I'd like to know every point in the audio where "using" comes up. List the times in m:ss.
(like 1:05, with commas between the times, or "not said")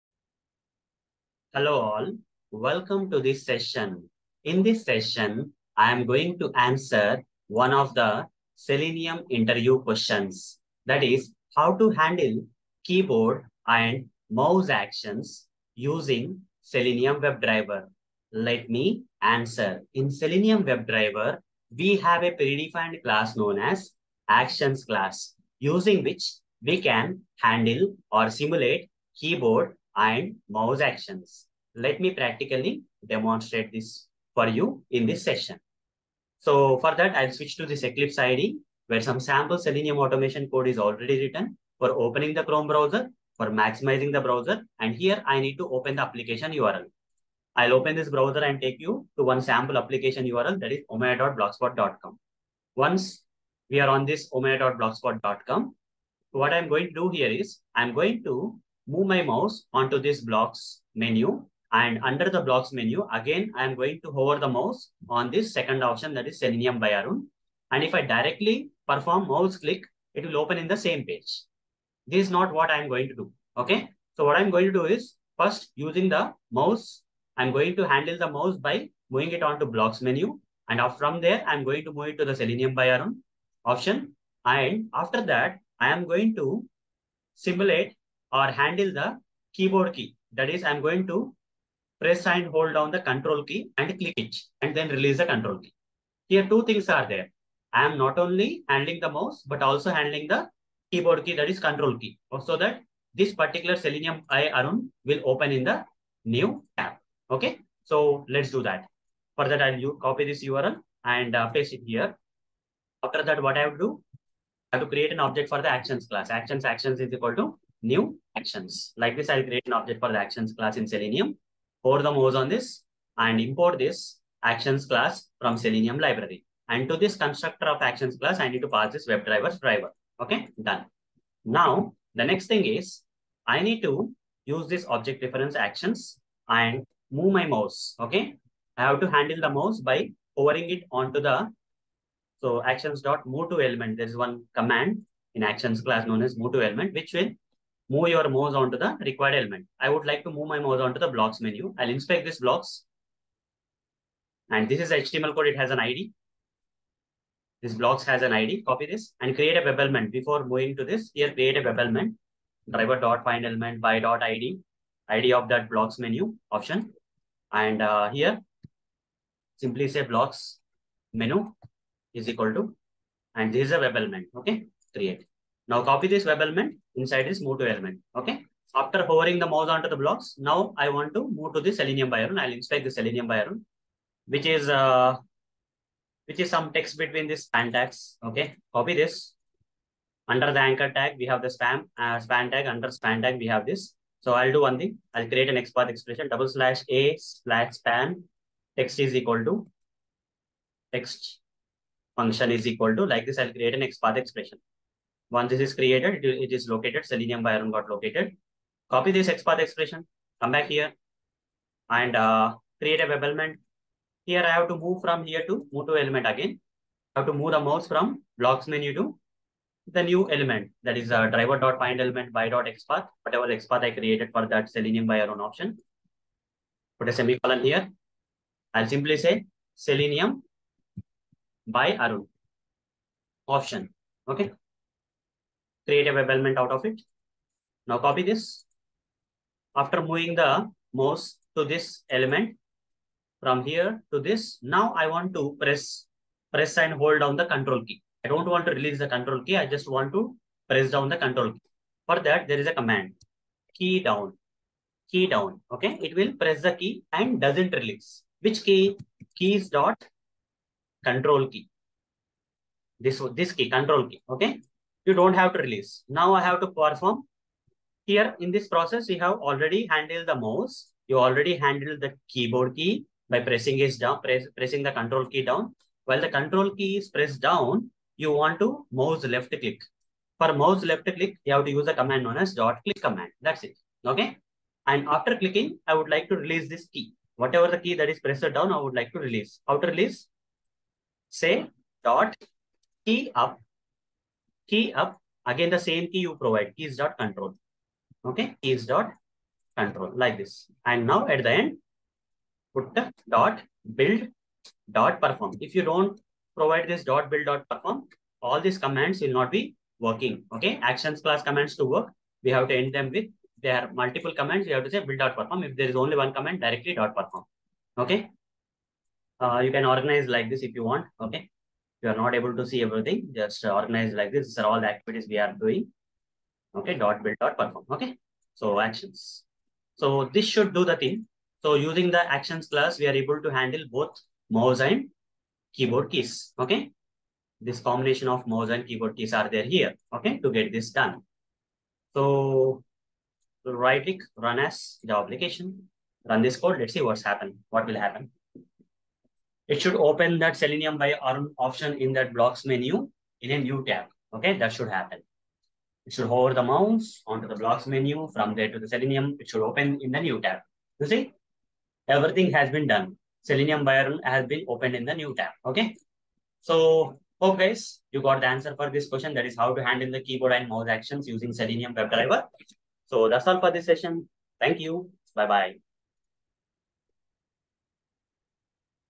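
0:15, 0:25, 1:15, 5:31, 6:11.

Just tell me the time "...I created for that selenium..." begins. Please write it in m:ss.
3:43.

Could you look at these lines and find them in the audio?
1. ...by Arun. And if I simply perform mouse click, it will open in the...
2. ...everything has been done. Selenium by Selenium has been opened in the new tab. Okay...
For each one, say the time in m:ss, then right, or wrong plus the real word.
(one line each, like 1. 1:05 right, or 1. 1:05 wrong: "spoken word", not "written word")
1. 1:06 wrong: "directly", not "simply"
2. 6:02 wrong: "Arun", not "Selenium".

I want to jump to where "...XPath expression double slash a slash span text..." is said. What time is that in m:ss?
3:15.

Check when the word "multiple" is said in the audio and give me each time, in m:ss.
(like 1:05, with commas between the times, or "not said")
5:13.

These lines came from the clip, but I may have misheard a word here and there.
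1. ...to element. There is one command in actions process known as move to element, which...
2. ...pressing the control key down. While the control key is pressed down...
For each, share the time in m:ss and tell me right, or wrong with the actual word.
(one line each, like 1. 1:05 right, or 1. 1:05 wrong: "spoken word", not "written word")
1. 2:23 wrong: "class", not "process"
2. 4:34 right.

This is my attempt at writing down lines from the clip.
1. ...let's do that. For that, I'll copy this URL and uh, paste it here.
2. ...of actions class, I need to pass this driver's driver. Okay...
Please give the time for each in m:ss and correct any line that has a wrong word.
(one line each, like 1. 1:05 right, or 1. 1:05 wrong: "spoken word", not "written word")
1. 1:48 right
2. 2:07 right.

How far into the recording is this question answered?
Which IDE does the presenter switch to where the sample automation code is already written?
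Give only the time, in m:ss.
0:37.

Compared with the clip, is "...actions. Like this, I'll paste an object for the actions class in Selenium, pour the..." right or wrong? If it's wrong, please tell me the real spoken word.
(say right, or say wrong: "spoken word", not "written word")
wrong: "create", not "paste".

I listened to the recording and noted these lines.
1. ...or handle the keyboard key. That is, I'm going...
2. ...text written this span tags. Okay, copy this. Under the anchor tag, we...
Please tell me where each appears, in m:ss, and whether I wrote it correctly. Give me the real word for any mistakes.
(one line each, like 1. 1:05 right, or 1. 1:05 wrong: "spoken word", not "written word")
1. 1:28 right
2. 3:06 wrong: "between", not "written".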